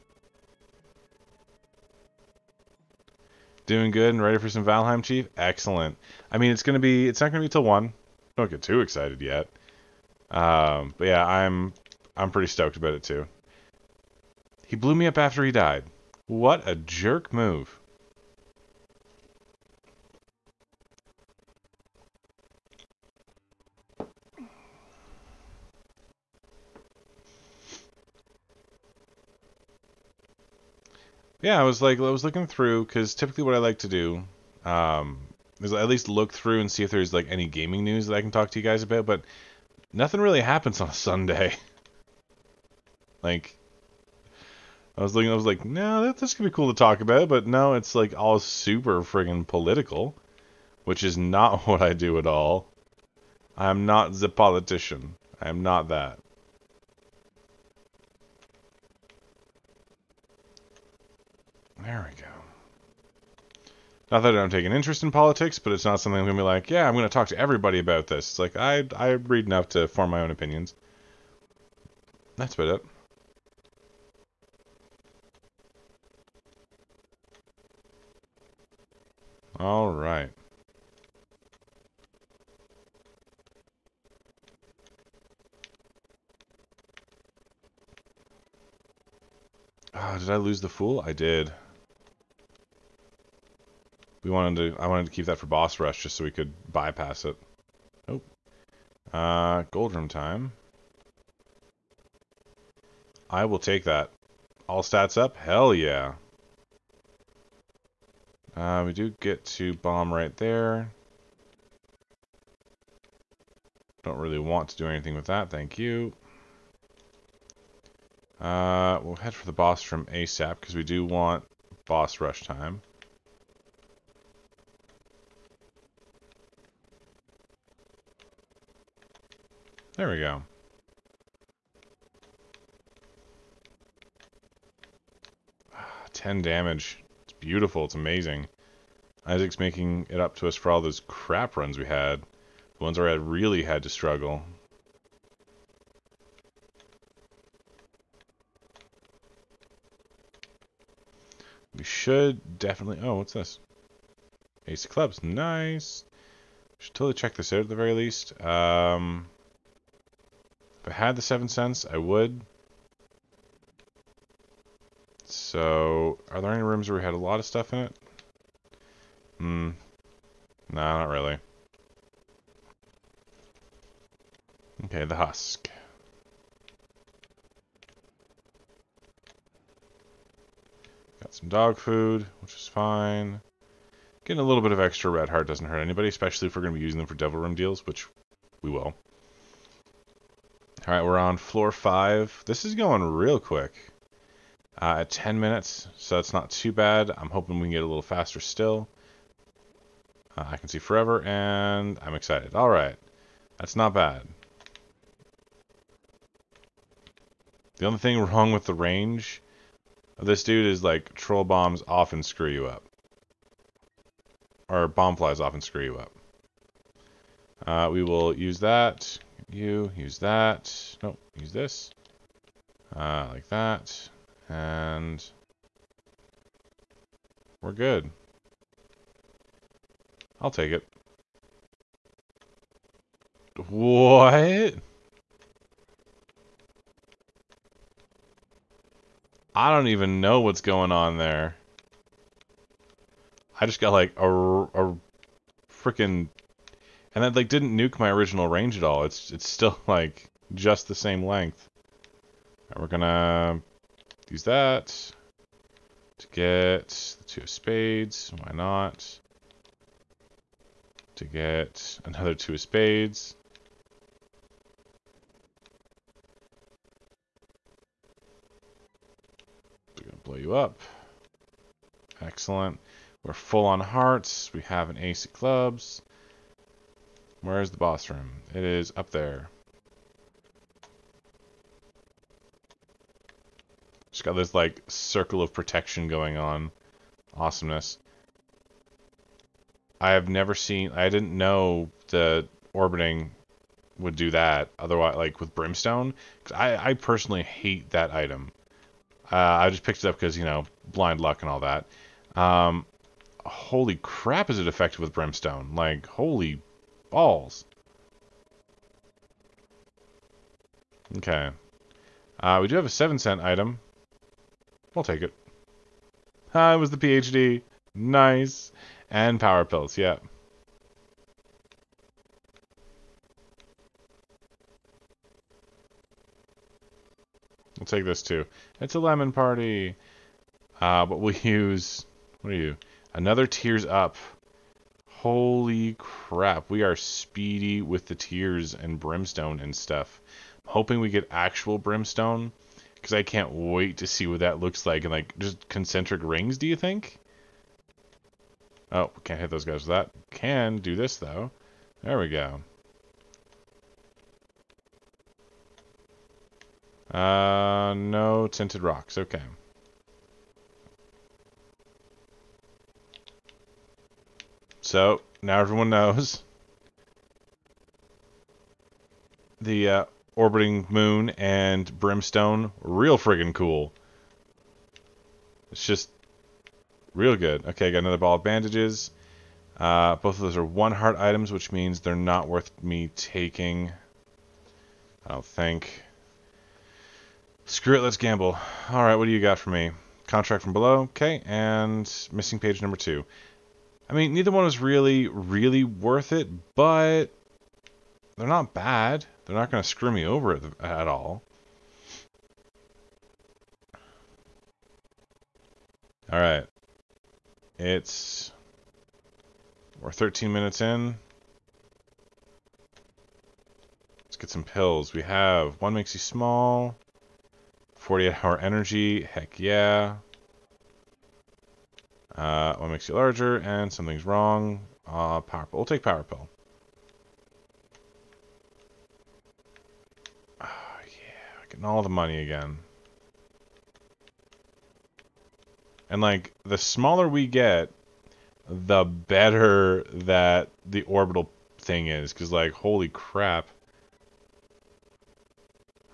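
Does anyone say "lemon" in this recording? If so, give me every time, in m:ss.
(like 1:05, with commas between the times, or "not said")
5:28.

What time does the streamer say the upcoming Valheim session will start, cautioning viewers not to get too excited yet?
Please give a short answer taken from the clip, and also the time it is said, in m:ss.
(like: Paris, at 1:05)
1, at 0:07.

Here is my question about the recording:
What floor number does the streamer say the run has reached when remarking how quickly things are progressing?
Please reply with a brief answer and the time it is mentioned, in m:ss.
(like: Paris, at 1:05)
5, at 3:11.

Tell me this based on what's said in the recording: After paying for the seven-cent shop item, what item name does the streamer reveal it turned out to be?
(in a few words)
PhD.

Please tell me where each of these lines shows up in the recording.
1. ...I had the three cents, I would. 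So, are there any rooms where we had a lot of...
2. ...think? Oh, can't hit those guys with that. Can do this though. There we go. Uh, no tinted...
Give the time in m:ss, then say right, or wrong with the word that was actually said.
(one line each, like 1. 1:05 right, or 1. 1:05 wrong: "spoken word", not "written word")
1. 2:40 wrong: "seven", not "three"
2. 5:46 right.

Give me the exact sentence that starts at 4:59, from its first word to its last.
Uh, I just picked it up because, you know, blind luck and all that.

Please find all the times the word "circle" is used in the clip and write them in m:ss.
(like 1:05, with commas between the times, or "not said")
4:44.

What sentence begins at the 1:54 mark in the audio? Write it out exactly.
Don't really want to do anything with that, thank you.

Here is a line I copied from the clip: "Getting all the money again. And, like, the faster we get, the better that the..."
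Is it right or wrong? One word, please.
wrong.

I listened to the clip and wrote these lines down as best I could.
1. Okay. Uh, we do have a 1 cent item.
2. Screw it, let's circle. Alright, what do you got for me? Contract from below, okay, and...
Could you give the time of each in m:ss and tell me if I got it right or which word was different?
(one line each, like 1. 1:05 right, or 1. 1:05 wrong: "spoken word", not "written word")
1. 5:11 wrong: "7", not "1"
2. 6:27 wrong: "gamble", not "circle".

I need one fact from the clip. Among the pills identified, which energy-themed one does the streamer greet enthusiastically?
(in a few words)
48 hour energy.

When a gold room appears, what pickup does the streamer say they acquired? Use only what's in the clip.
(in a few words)
All stats up.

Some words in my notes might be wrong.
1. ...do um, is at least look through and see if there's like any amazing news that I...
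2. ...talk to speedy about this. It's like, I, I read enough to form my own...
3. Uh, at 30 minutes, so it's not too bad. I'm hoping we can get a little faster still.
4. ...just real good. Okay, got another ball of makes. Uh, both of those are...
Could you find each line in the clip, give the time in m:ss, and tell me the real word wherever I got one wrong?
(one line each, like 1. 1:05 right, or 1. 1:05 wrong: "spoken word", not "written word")
1. 0:33 wrong: "gaming", not "amazing"
2. 1:07 wrong: "everybody", not "speedy"
3. 3:14 wrong: "10", not "30"
4. 6:15 wrong: "bandages", not "makes".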